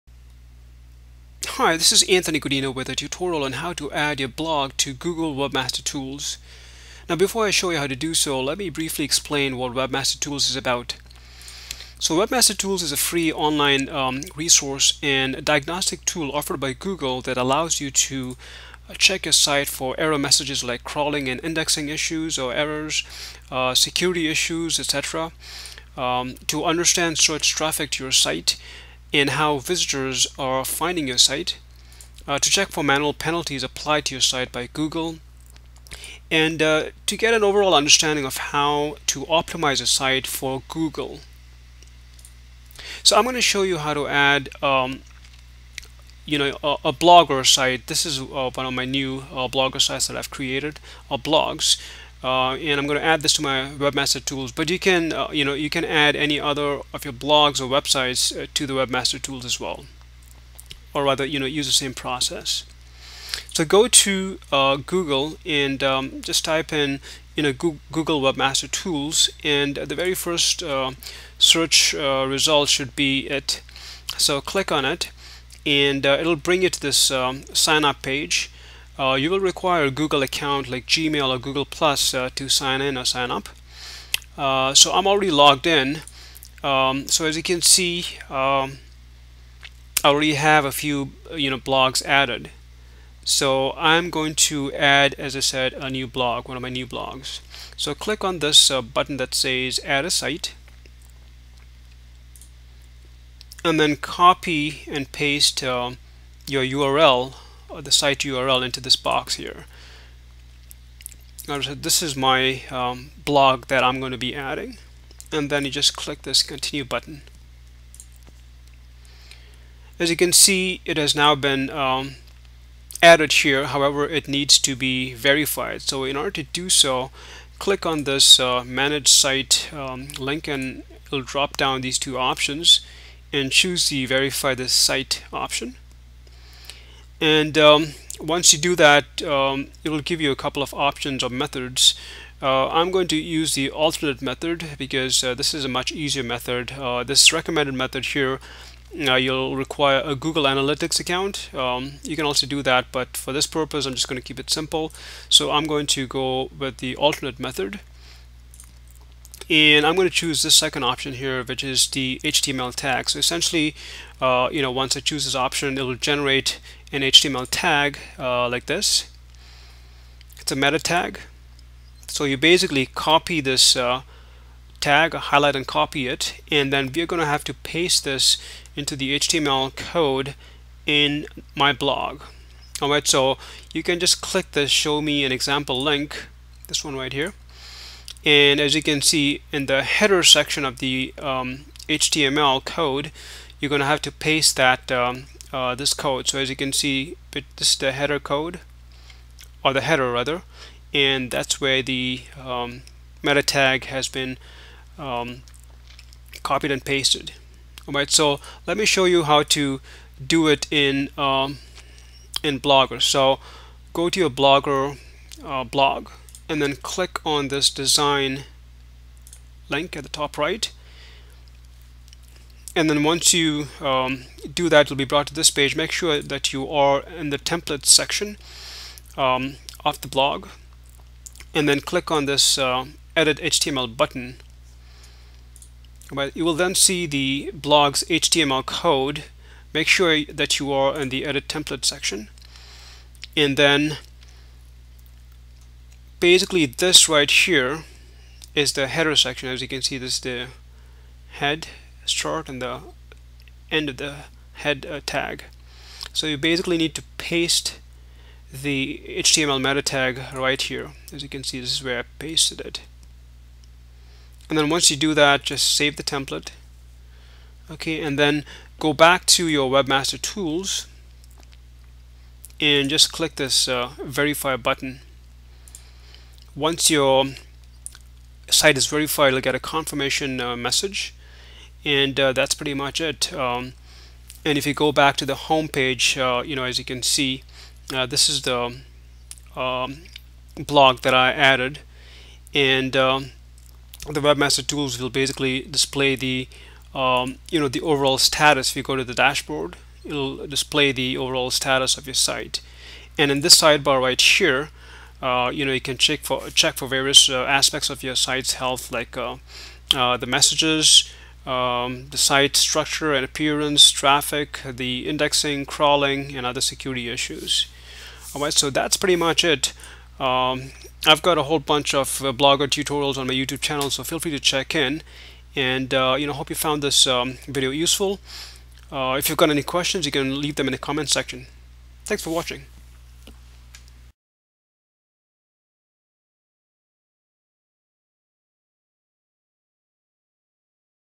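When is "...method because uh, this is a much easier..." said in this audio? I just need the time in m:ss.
2:24.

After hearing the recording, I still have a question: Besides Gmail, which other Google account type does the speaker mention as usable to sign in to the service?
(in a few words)
Google Plus.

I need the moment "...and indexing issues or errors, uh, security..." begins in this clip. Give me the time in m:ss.
0:21.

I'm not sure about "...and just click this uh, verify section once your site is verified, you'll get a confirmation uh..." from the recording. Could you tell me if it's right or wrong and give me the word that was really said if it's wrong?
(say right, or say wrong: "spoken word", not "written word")
wrong: "button", not "section".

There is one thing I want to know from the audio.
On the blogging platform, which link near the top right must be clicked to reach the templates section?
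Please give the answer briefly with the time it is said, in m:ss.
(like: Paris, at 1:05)
design, at 3:37.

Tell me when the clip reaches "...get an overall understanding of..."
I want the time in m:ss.
0:37.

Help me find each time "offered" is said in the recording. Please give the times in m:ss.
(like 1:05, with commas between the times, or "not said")
0:16.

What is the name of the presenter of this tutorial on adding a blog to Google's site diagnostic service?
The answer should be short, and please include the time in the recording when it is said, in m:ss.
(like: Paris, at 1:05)
Anthony Godinho, at 0:02.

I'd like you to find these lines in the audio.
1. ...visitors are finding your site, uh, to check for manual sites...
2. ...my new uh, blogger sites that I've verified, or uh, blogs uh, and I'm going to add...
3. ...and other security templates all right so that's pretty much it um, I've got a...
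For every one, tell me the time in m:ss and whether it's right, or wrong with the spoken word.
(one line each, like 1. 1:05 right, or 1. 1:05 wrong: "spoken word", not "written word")
1. 0:29 wrong: "penalties", not "sites"
2. 0:48 wrong: "created", not "verified"
3. 5:16 wrong: "issues", not "templates".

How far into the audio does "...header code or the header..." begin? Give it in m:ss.
3:17.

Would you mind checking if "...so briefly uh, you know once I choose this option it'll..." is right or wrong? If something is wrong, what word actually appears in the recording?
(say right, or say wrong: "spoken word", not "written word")
wrong: "essentially", not "briefly".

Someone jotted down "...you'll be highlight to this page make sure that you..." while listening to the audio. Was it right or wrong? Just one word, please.
wrong.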